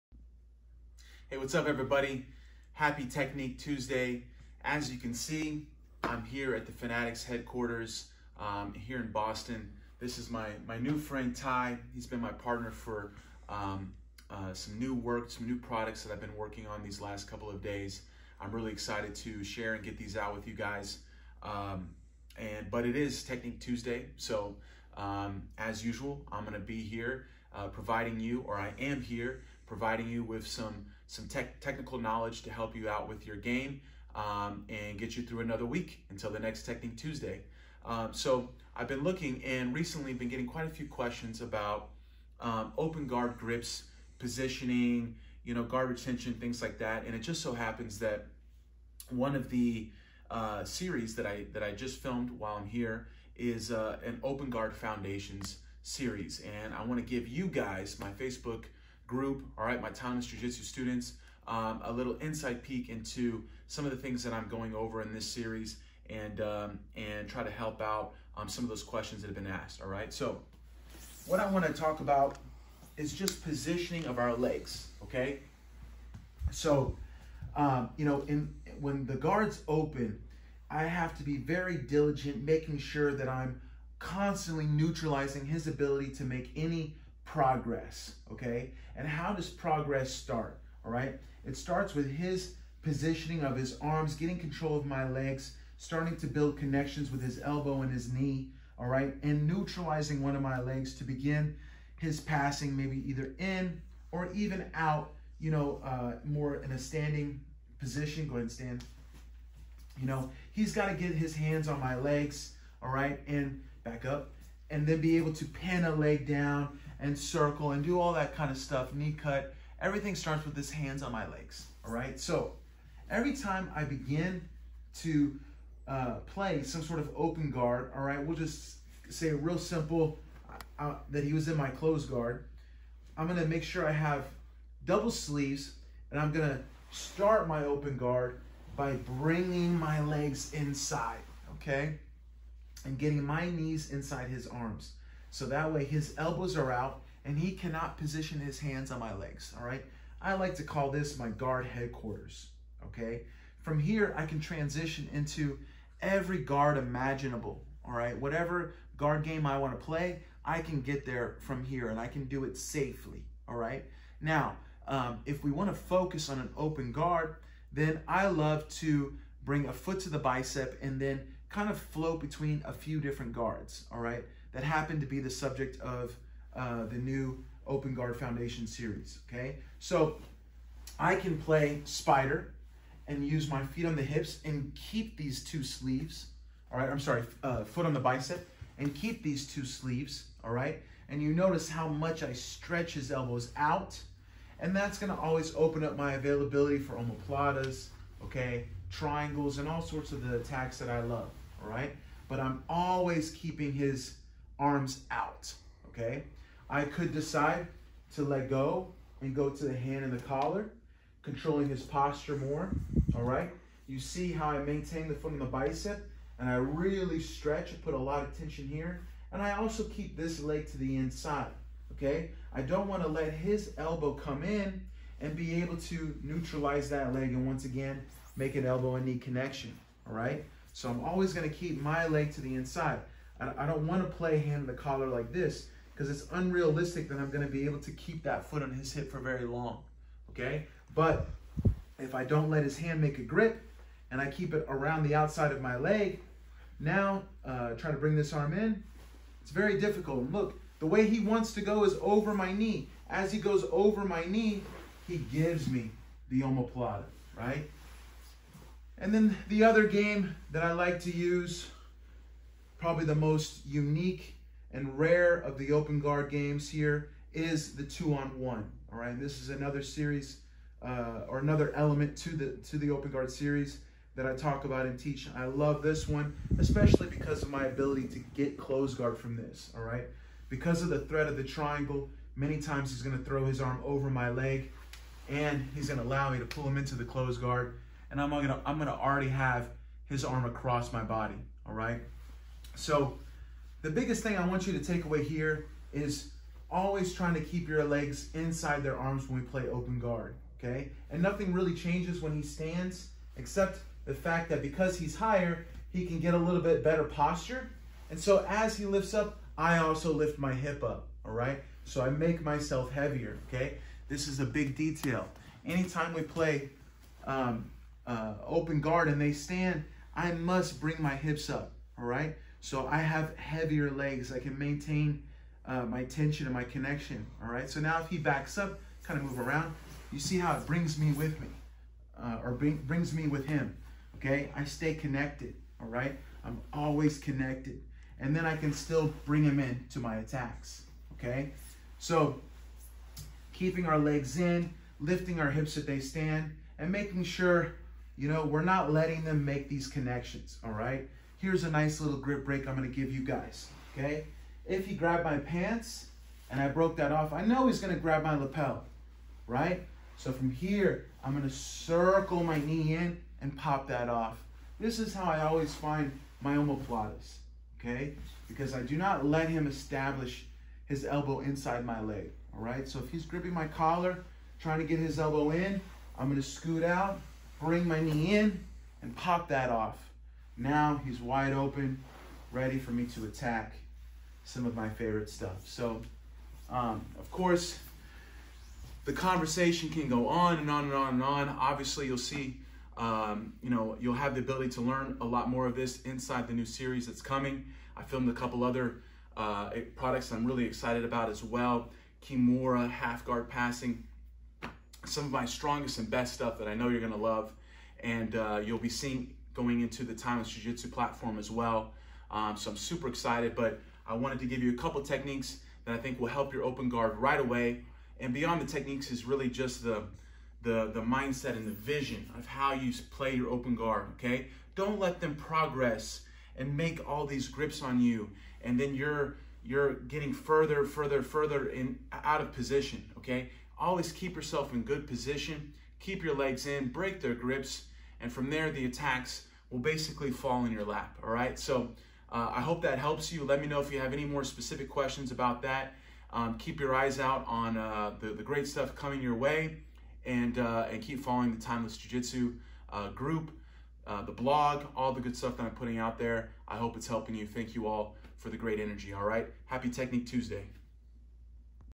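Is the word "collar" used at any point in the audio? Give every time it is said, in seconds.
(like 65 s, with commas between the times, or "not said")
210 s, 234 s, 373 s.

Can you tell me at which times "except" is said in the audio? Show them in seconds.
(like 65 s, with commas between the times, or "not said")
303 s.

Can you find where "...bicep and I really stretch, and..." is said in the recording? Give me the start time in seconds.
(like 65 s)
215 s.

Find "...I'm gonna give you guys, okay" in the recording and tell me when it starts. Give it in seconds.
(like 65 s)
352 s.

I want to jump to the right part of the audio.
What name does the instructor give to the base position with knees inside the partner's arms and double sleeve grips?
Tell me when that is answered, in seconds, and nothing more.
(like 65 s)
151 s.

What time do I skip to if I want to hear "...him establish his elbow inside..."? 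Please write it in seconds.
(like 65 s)
369 s.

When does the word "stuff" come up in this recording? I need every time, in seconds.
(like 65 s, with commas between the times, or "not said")
118 s, 385 s, 406 s, 448 s, 455 s.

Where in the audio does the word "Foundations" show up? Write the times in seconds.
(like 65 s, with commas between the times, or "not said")
54 s, 178 s.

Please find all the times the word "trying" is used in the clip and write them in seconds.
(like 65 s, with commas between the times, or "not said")
297 s, 374 s.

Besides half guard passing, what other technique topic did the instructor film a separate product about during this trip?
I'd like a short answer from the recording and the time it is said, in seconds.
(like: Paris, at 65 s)
Kimura, at 402 s.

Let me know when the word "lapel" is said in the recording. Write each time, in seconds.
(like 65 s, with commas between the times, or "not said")
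358 s.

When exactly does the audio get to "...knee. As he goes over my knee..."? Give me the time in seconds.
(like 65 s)
252 s.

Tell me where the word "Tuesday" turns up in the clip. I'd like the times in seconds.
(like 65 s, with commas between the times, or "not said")
3 s, 23 s, 36 s, 460 s.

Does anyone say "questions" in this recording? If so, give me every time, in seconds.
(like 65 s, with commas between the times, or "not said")
40 s, 68 s, 444 s.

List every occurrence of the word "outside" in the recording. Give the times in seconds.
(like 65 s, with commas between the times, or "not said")
245 s.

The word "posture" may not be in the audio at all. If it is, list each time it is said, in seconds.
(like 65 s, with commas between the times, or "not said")
211 s, 307 s.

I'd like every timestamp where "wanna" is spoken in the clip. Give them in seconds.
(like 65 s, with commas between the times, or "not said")
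71 s, 159 s, 165 s, 222 s.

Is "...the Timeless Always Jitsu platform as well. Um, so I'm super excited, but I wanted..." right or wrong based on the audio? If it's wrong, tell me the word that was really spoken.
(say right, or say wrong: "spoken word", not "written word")
wrong: "Jiu", not "Always".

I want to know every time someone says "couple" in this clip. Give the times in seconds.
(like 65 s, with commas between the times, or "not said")
17 s, 398 s, 414 s.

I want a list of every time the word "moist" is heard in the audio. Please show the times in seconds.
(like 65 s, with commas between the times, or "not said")
not said.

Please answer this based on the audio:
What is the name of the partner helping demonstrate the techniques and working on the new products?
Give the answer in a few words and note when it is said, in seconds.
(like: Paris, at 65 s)
Ty, at 11 s.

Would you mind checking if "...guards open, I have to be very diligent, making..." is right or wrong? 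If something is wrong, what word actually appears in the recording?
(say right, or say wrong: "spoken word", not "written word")
right.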